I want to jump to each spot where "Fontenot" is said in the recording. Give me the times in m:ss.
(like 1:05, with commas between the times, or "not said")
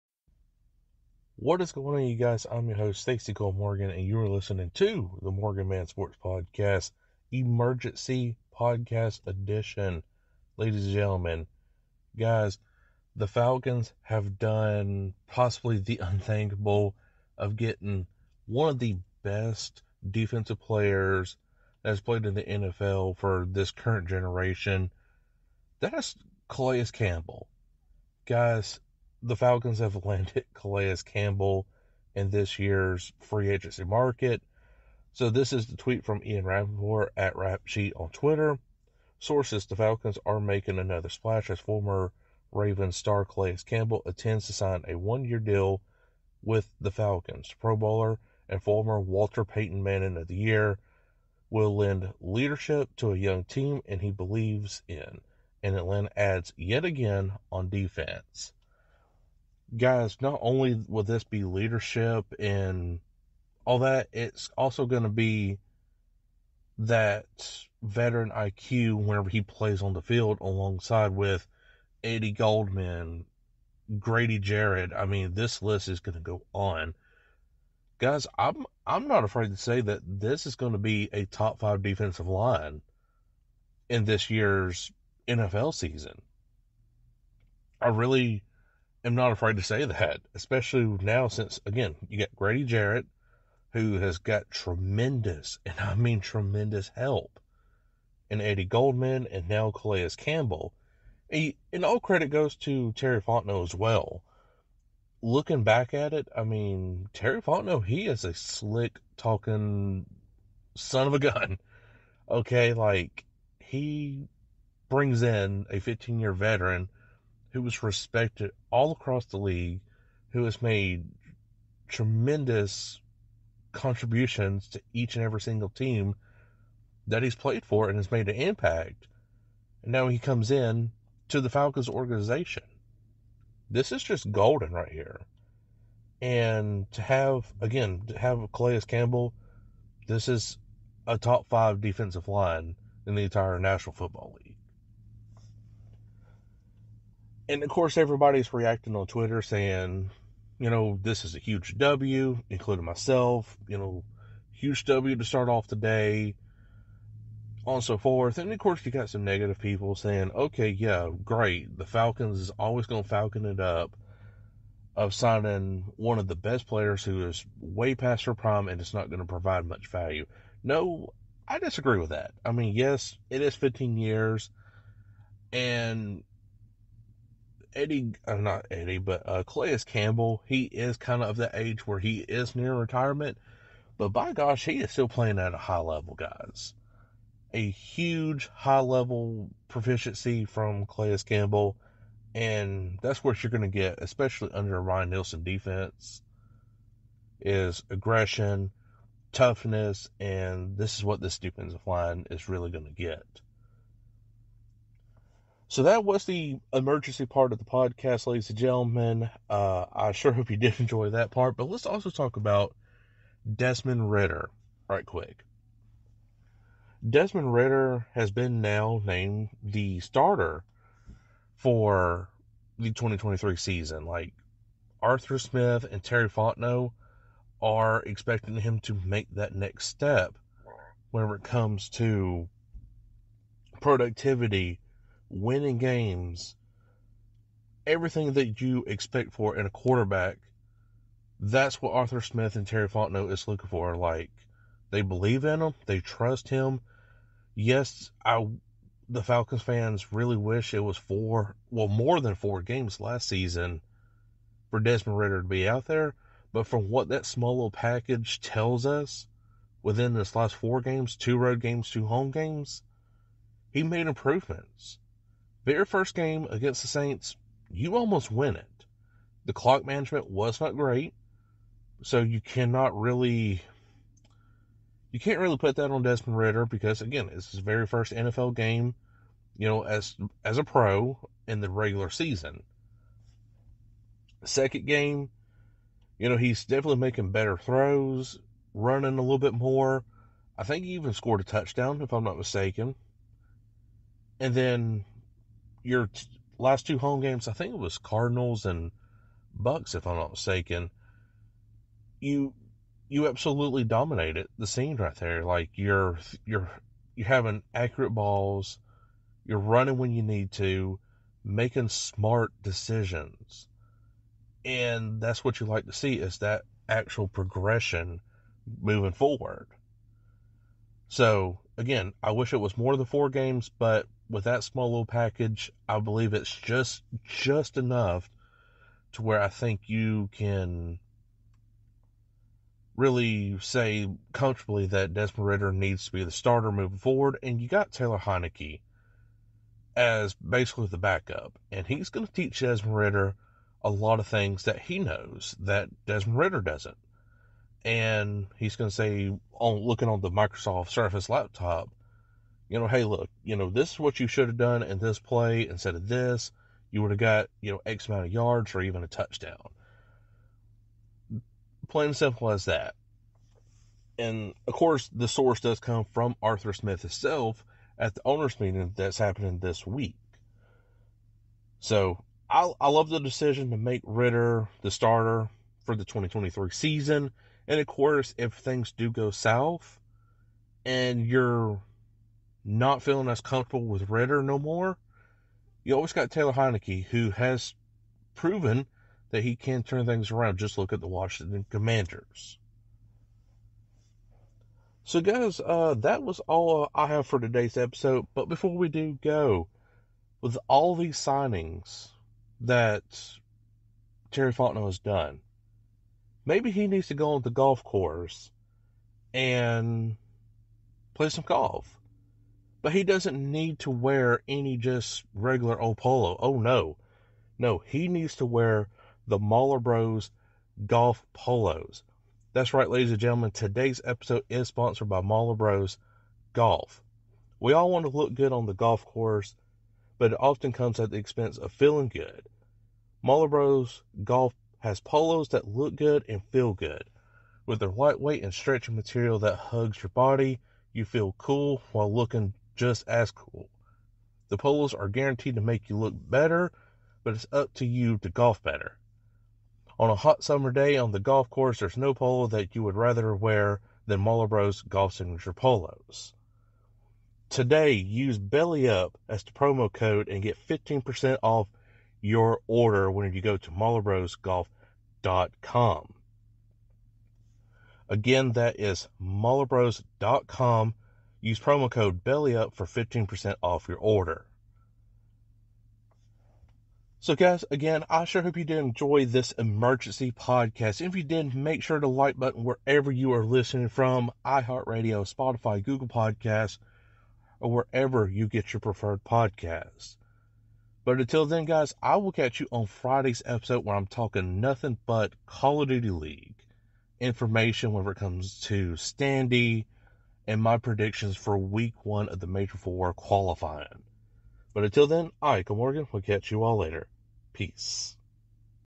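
1:43, 1:47, 3:46, 4:02, 6:44.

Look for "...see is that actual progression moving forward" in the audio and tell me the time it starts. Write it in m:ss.
5:15.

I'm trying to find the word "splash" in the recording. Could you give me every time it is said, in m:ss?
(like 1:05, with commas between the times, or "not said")
0:41.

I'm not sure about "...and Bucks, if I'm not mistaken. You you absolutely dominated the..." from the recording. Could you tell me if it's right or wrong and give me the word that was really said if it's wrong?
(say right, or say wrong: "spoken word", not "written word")
right.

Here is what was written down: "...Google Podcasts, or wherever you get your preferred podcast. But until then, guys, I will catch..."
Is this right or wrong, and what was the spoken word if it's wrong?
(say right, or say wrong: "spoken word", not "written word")
right.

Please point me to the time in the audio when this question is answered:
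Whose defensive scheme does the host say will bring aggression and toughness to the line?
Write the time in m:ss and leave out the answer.
3:14.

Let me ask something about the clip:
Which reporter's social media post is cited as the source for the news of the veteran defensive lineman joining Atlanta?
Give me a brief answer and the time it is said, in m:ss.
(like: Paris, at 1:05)
Ian Rapoport, at 0:36.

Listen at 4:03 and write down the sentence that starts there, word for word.
Like they believe in him, they trust him.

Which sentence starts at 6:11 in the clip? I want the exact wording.
So I, I love the decision to make Ridder the starter for the 2023 season.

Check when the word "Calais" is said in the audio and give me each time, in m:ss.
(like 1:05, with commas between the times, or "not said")
0:26, 0:30, 0:43, 1:39, 2:18, 2:59, 3:10.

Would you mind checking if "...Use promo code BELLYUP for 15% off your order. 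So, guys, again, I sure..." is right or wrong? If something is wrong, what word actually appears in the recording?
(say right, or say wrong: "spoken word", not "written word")
right.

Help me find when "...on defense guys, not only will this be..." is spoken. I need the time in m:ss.
0:57.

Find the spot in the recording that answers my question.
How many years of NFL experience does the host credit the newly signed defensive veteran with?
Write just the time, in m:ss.
1:55.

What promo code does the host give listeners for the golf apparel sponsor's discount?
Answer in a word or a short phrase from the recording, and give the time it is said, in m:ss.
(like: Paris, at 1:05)
BELLYUP, at 7:38.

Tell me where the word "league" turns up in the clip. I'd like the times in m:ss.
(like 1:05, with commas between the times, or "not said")
1:59, 2:24, 8:16.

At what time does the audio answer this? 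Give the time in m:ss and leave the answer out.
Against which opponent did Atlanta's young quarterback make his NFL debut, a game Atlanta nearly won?
4:26.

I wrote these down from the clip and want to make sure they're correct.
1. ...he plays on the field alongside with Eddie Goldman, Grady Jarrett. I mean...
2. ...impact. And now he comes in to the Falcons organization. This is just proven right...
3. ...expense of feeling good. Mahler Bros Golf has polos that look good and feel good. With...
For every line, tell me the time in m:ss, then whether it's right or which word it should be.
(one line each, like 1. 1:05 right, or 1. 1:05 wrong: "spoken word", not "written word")
1. 1:09 right
2. 2:08 wrong: "golden", not "proven"
3. 7:11 right.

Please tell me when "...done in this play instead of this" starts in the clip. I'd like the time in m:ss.
5:54.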